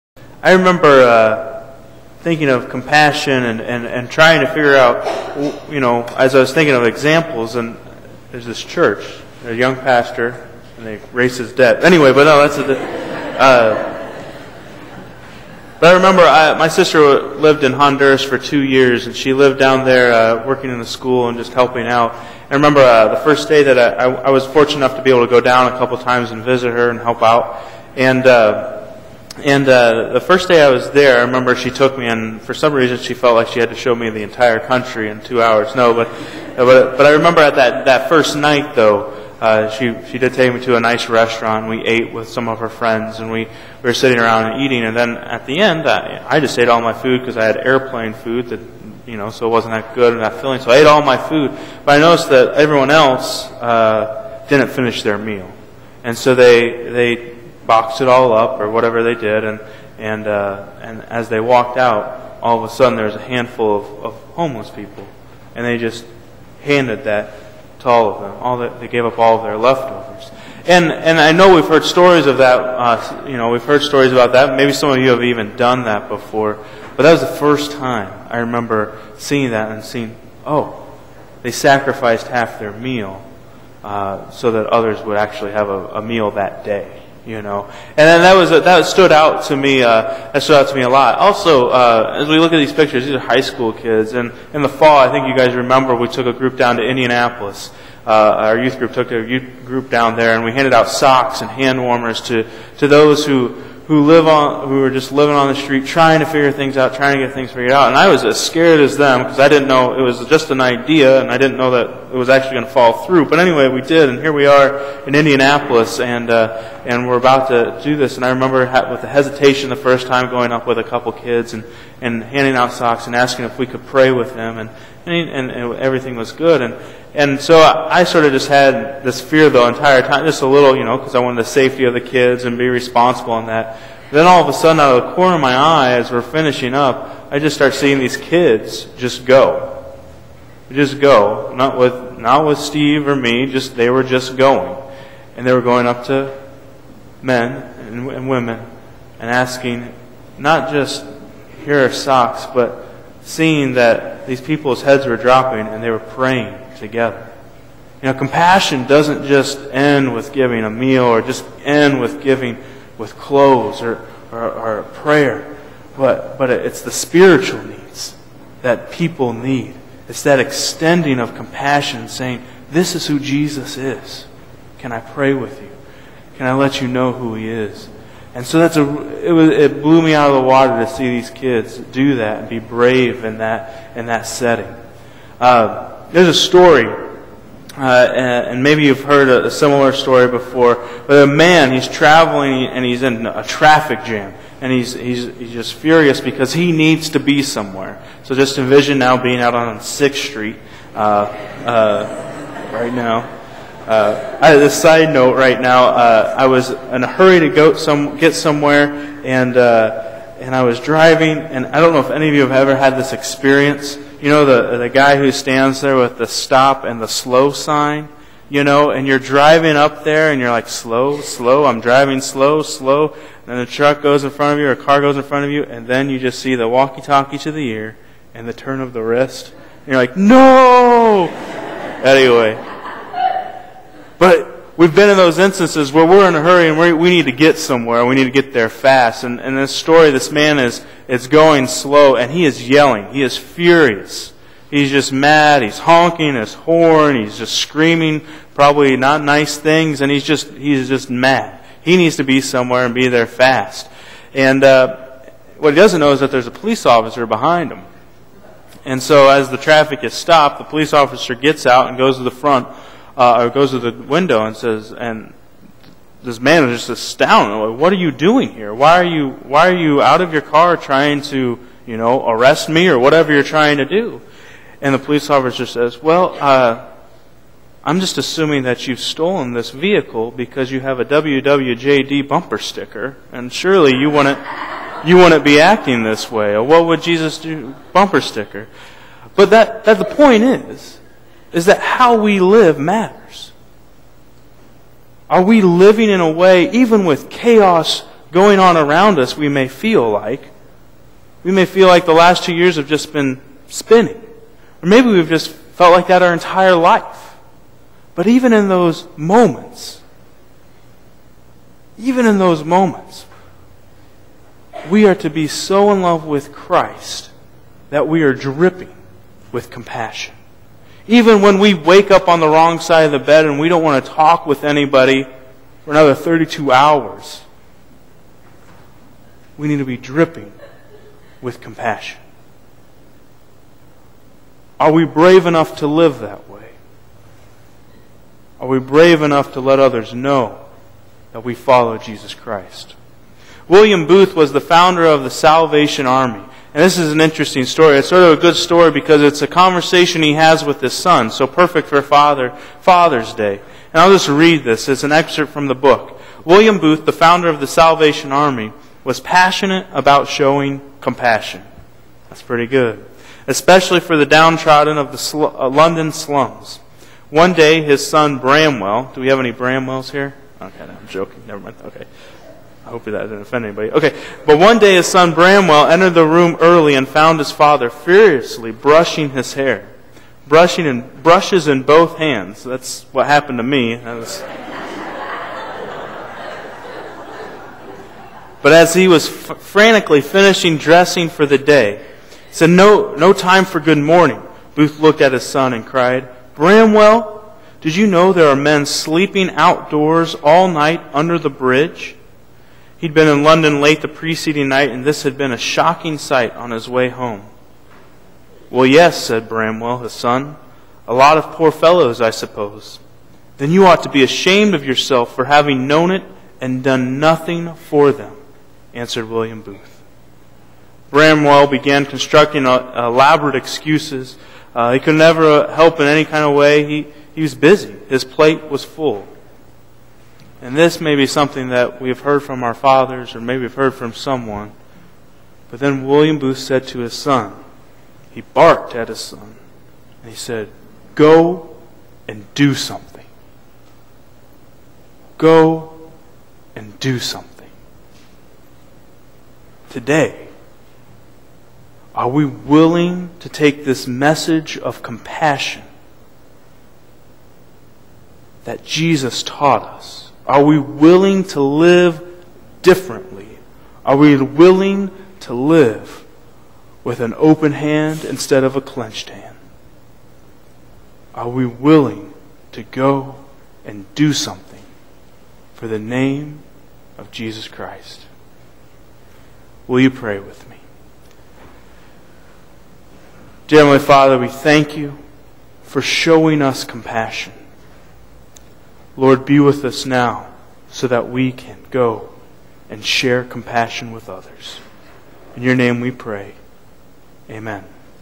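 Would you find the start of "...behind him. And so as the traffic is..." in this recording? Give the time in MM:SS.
04:17.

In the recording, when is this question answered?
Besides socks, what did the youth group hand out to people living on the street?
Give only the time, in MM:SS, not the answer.
01:41.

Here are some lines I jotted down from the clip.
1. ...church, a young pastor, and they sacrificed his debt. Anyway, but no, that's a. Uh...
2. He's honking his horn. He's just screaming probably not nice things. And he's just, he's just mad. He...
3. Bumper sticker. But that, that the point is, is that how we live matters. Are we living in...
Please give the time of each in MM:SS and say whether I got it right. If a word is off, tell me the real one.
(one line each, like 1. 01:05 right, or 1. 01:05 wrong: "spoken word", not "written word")
1. 00:08 wrong: "raised", not "sacrificed"
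2. 04:05 right
3. 04:47 right.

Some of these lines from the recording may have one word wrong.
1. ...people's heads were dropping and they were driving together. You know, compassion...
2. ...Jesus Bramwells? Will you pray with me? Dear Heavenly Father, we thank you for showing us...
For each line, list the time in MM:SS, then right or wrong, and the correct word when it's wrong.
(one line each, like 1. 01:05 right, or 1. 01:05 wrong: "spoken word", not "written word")
1. 02:34 wrong: "praying", not "driving"
2. 07:57 wrong: "Christ", not "Bramwells".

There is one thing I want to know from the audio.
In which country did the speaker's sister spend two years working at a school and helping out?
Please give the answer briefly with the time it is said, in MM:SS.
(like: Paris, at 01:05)
Honduras, at 00:17.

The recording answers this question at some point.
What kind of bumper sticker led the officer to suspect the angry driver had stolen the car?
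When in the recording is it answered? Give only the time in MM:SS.
04:41.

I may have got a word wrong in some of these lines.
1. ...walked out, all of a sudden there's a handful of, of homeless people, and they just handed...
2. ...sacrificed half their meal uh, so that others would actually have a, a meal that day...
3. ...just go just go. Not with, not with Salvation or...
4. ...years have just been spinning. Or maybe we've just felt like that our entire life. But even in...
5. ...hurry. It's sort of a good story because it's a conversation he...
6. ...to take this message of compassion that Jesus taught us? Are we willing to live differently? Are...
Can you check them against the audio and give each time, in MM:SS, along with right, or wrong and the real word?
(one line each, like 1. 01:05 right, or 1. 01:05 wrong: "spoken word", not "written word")
1. 01:01 right
2. 01:21 right
3. 02:18 wrong: "Steve", not "Salvation"
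4. 05:02 right
5. 05:47 wrong: "story", not "hurry"
6. 07:33 right.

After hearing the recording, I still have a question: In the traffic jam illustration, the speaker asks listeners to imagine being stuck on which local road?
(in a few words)
6th Street.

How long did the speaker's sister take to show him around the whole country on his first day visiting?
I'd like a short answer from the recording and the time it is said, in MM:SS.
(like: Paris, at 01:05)
2 hours, at 00:35.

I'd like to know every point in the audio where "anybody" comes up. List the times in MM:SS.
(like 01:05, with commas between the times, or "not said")
05:24, 06:13.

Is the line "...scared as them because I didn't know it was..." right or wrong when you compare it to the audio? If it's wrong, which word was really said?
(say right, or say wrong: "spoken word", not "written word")
right.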